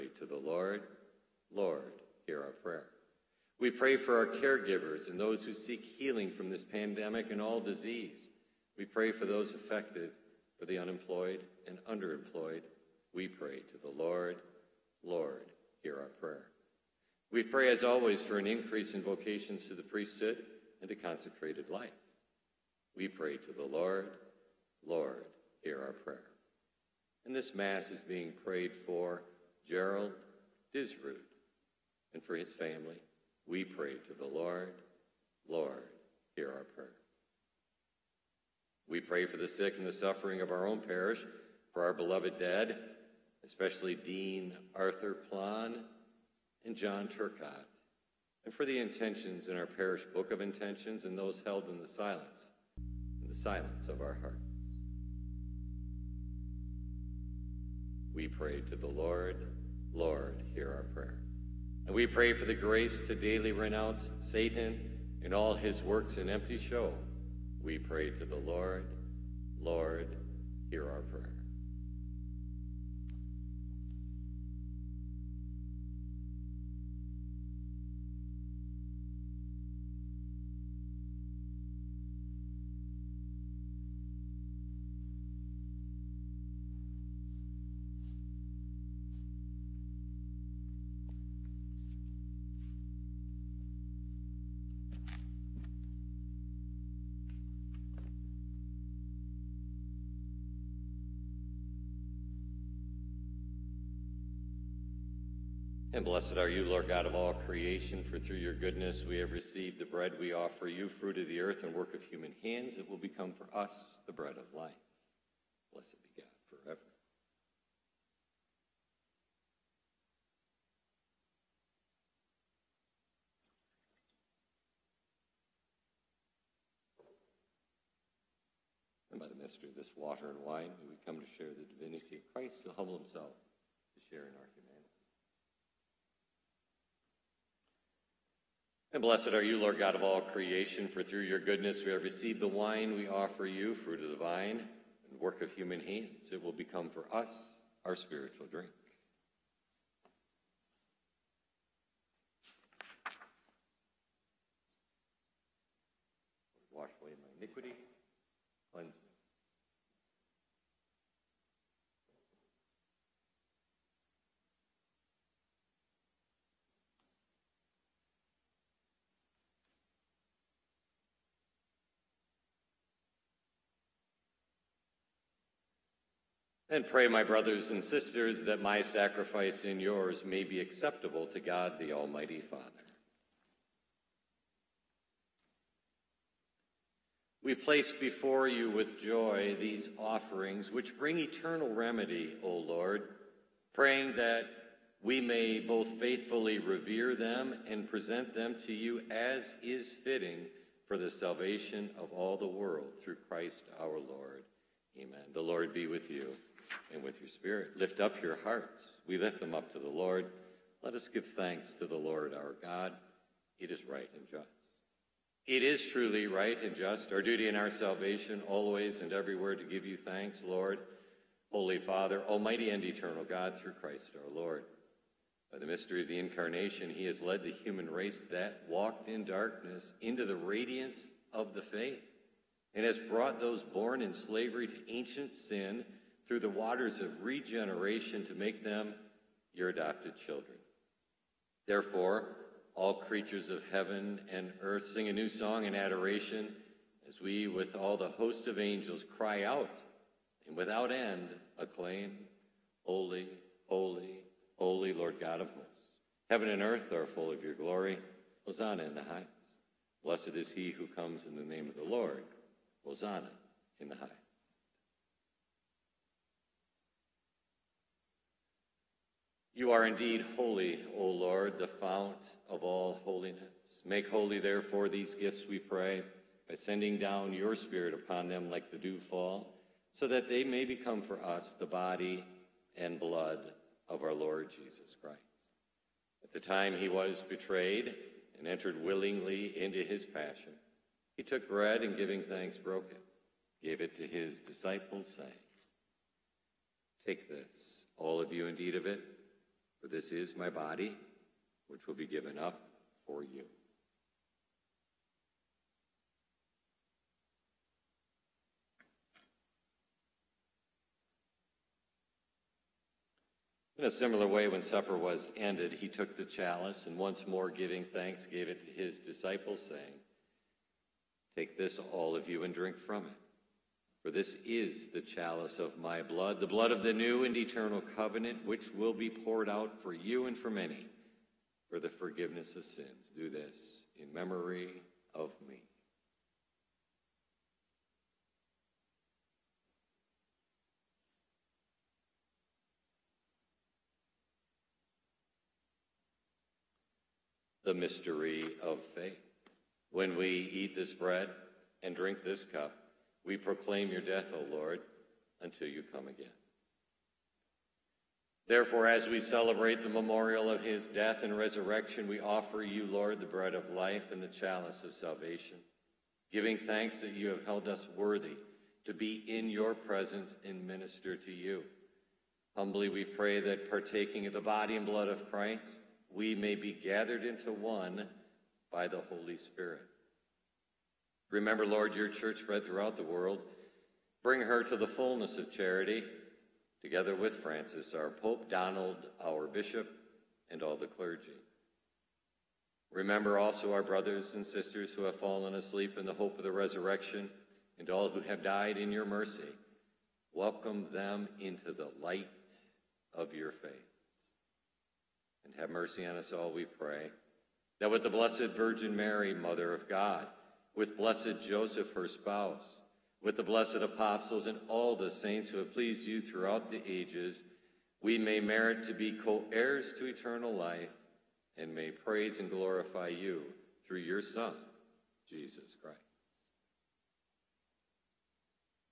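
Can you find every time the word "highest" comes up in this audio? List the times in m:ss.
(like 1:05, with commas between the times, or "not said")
4:19, 4:23.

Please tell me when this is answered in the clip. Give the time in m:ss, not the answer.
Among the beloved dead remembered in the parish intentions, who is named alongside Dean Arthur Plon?
0:46.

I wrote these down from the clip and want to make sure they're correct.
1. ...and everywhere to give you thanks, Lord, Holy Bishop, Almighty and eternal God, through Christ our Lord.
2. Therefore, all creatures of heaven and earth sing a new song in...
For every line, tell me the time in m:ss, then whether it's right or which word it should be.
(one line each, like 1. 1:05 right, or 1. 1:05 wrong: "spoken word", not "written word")
1. 3:39 wrong: "Father", not "Bishop"
2. 4:01 right.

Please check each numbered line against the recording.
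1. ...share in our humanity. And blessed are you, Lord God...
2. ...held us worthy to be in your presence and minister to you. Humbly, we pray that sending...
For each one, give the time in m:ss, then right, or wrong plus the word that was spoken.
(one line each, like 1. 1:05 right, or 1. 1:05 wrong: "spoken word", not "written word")
1. 2:14 right
2. 6:07 wrong: "partaking", not "sending".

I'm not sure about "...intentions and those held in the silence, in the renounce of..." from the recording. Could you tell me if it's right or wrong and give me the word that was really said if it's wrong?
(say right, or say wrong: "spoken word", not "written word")
wrong: "silence", not "renounce".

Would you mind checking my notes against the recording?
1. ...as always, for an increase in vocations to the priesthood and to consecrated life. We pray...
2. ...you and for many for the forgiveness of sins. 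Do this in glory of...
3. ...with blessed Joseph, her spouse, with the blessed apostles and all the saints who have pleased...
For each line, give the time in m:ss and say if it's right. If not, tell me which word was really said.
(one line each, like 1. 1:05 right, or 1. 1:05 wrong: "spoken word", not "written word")
1. 0:17 right
2. 5:29 wrong: "memory", not "glory"
3. 6:50 right.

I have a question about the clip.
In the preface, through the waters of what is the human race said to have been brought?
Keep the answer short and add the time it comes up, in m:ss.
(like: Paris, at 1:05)
regeneration, at 3:57.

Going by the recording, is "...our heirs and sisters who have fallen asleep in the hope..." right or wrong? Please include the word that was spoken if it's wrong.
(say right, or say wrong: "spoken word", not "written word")
wrong: "brothers", not "heirs".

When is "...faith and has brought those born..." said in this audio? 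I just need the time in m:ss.
3:51.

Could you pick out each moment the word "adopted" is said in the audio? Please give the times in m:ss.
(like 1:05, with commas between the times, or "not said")
3:59.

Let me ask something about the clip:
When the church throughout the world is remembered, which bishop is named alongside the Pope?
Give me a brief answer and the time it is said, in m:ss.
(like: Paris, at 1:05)
Donald, at 6:28.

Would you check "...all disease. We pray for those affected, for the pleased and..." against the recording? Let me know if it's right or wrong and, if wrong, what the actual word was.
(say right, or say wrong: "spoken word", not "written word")
wrong: "unemployed", not "pleased".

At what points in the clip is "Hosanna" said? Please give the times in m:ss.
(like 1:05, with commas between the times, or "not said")
4:18, 4:22.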